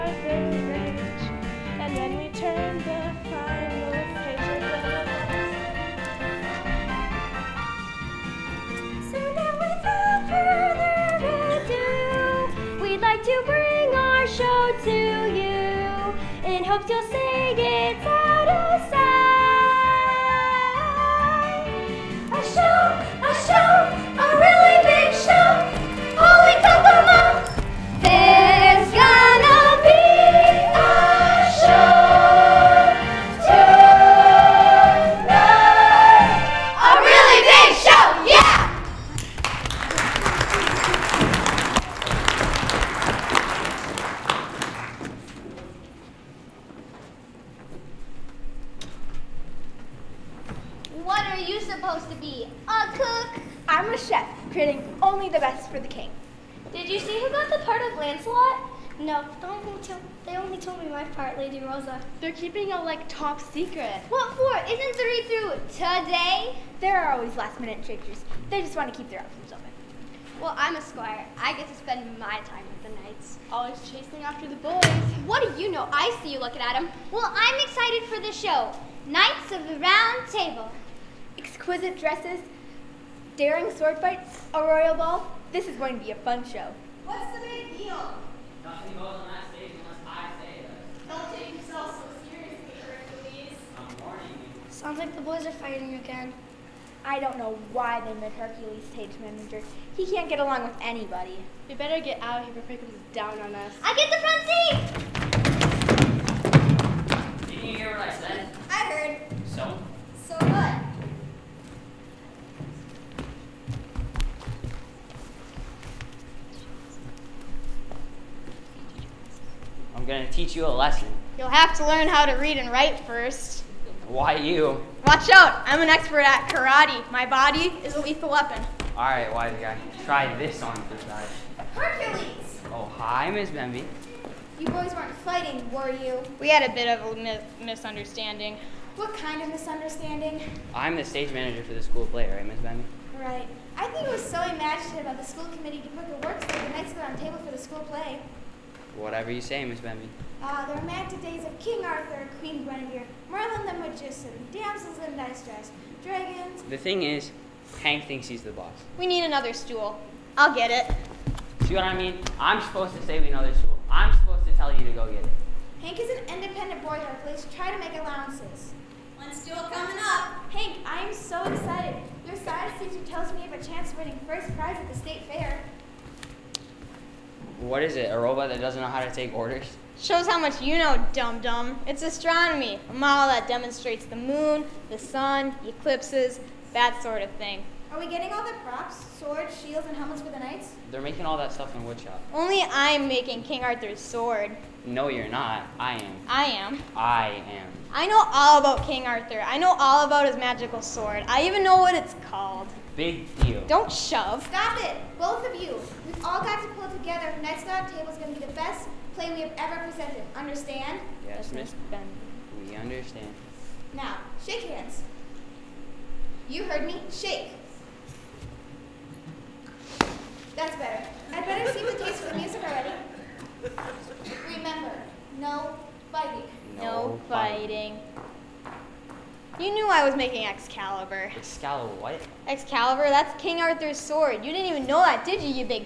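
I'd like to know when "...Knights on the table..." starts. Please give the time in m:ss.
2:26.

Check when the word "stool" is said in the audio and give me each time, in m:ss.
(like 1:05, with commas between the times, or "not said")
2:39, 2:43, 2:49.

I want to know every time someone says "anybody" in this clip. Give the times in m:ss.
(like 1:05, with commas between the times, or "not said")
1:40.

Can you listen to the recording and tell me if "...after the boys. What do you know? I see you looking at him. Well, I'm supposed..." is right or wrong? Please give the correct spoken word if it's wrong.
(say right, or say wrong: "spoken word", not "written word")
wrong: "excited", not "supposed".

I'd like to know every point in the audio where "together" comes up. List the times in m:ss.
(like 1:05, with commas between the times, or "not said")
3:26.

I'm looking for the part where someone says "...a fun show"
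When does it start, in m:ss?
1:26.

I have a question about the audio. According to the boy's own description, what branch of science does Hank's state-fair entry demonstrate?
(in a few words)
Astronomy.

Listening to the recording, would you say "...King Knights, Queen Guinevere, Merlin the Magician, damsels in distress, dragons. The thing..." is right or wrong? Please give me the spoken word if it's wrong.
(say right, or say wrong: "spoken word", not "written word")
wrong: "Arthur", not "Knights".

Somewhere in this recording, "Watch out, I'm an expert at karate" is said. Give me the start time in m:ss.
2:05.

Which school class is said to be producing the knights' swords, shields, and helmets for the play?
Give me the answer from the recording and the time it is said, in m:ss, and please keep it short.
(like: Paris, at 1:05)
Woodshop, at 3:11.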